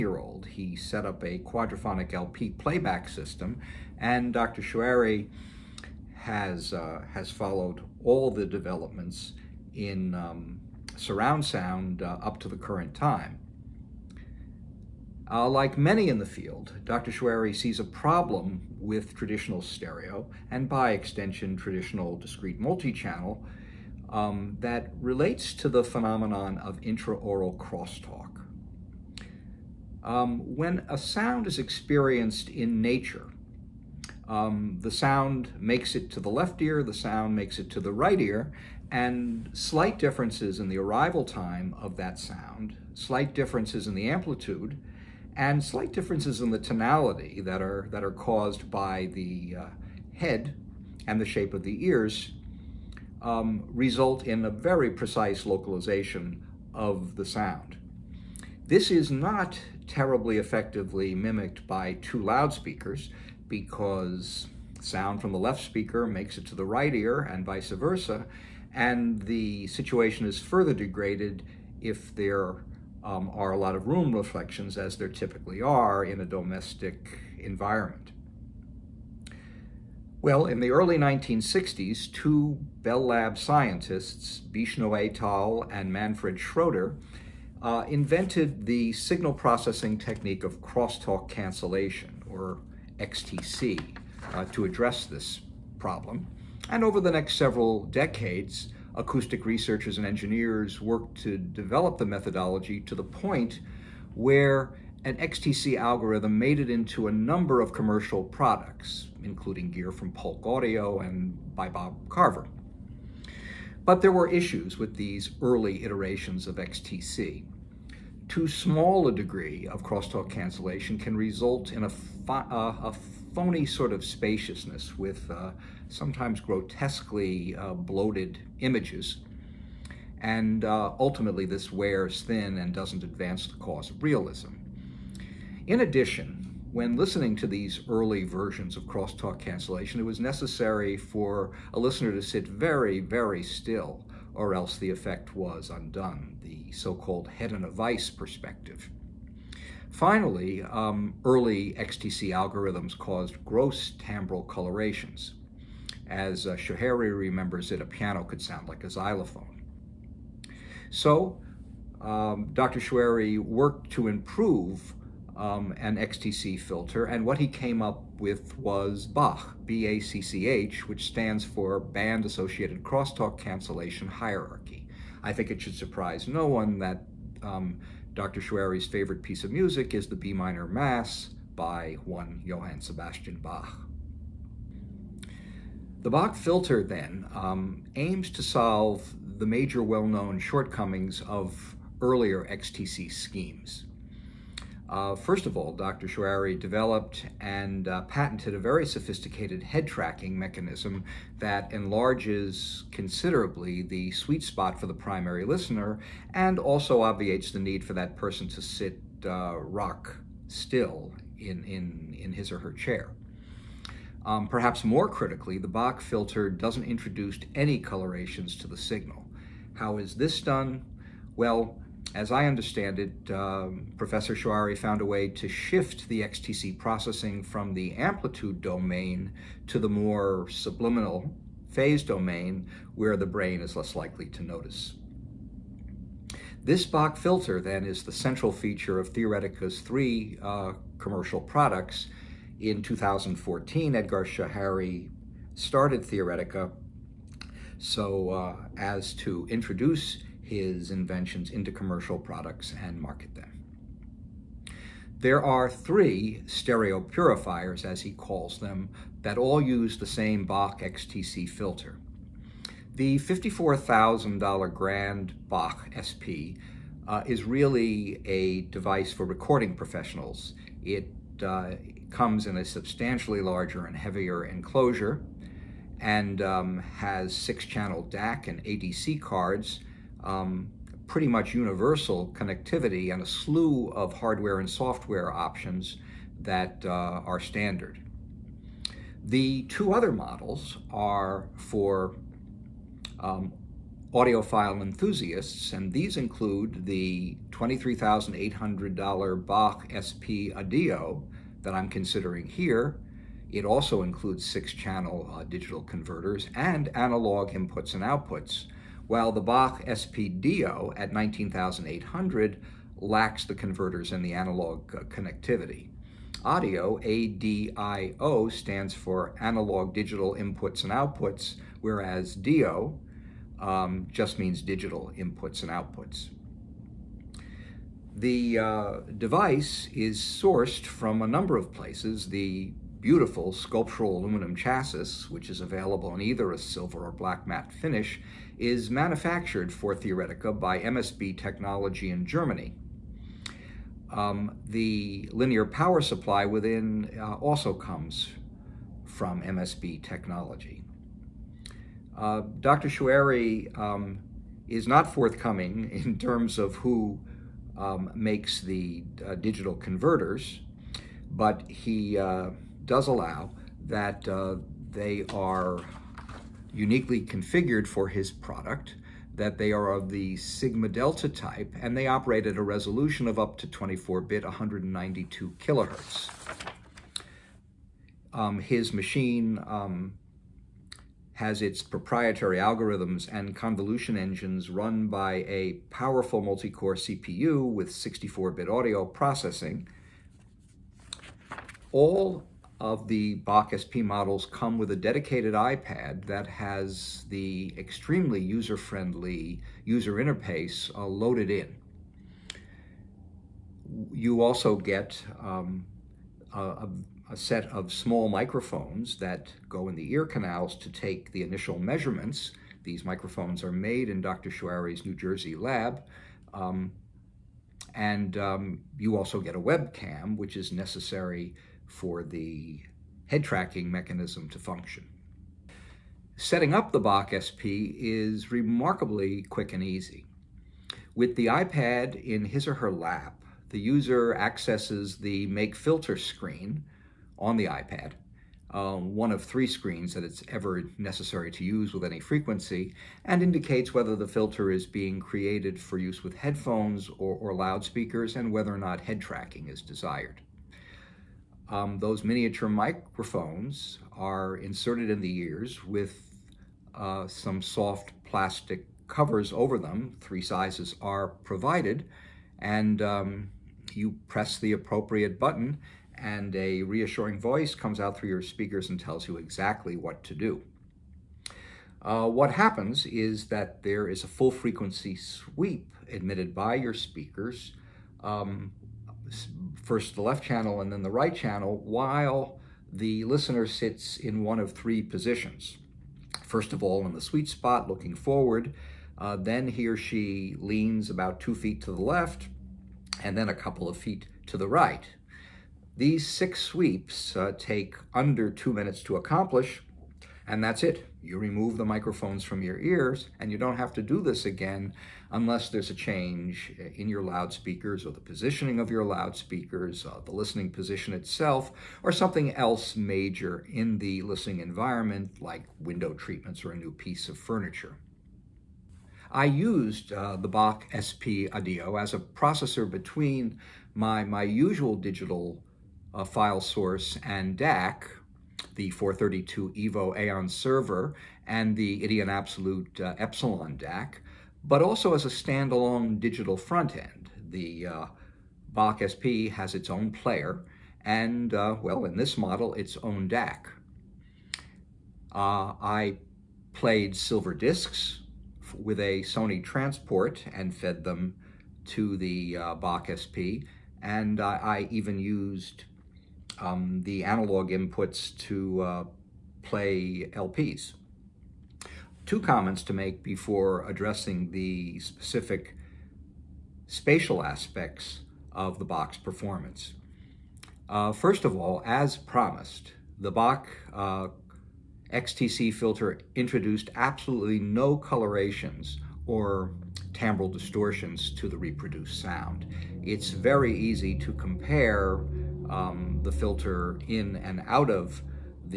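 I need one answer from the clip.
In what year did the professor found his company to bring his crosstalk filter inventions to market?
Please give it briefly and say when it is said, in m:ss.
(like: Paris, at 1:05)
2014, at 4:02.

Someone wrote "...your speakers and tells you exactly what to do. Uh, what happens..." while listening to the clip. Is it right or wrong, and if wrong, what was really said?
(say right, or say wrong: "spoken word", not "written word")
right.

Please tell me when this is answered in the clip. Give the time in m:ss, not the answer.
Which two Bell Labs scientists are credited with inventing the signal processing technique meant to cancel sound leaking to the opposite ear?
1:24.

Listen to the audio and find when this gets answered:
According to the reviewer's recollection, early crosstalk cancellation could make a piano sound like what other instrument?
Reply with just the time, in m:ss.
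2:38.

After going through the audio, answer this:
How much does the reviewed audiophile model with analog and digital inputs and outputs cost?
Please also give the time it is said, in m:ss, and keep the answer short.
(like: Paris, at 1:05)
$23,800, at 4:57.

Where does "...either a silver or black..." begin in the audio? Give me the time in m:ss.
5:36.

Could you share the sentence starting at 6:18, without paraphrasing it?
Um, his machine um, has its proprietary algorithms and convolution engines run by a powerful multi-core CPU with 64-bit audio processing.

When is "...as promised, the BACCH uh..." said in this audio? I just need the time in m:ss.
9:31.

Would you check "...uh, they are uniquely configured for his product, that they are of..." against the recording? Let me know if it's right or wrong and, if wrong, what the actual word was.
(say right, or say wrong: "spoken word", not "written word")
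right.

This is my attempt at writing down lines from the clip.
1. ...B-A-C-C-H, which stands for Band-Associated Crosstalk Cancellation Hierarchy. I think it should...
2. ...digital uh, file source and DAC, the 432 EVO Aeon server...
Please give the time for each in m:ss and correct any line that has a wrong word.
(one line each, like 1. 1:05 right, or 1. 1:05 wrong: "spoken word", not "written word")
1. 2:49 right
2. 8:44 right.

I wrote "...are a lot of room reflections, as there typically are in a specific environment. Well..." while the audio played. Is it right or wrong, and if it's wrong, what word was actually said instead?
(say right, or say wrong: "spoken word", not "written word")
wrong: "domestic", not "specific".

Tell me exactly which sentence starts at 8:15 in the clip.
These six sweeps uh, take under two minutes to accomplish, and that's it.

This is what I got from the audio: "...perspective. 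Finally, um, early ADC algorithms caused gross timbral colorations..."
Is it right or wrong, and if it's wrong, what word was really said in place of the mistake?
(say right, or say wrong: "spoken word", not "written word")
wrong: "XTC", not "ADC".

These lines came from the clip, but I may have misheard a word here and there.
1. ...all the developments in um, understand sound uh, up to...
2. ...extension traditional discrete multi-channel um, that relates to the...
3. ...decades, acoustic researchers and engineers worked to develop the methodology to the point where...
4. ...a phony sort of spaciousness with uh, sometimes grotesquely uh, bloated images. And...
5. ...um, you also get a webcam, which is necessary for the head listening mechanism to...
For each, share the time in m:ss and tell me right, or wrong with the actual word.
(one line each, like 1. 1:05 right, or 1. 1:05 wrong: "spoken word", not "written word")
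1. 0:08 wrong: "surround", not "understand"
2. 0:20 right
3. 1:37 right
4. 2:02 right
5. 6:58 wrong: "tracking", not "listening".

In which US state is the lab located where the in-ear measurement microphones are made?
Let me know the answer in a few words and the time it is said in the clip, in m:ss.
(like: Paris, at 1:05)
New Jersey, at 6:55.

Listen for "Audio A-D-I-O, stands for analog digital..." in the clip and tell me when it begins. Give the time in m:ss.
5:16.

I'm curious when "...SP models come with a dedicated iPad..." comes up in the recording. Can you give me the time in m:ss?
6:33.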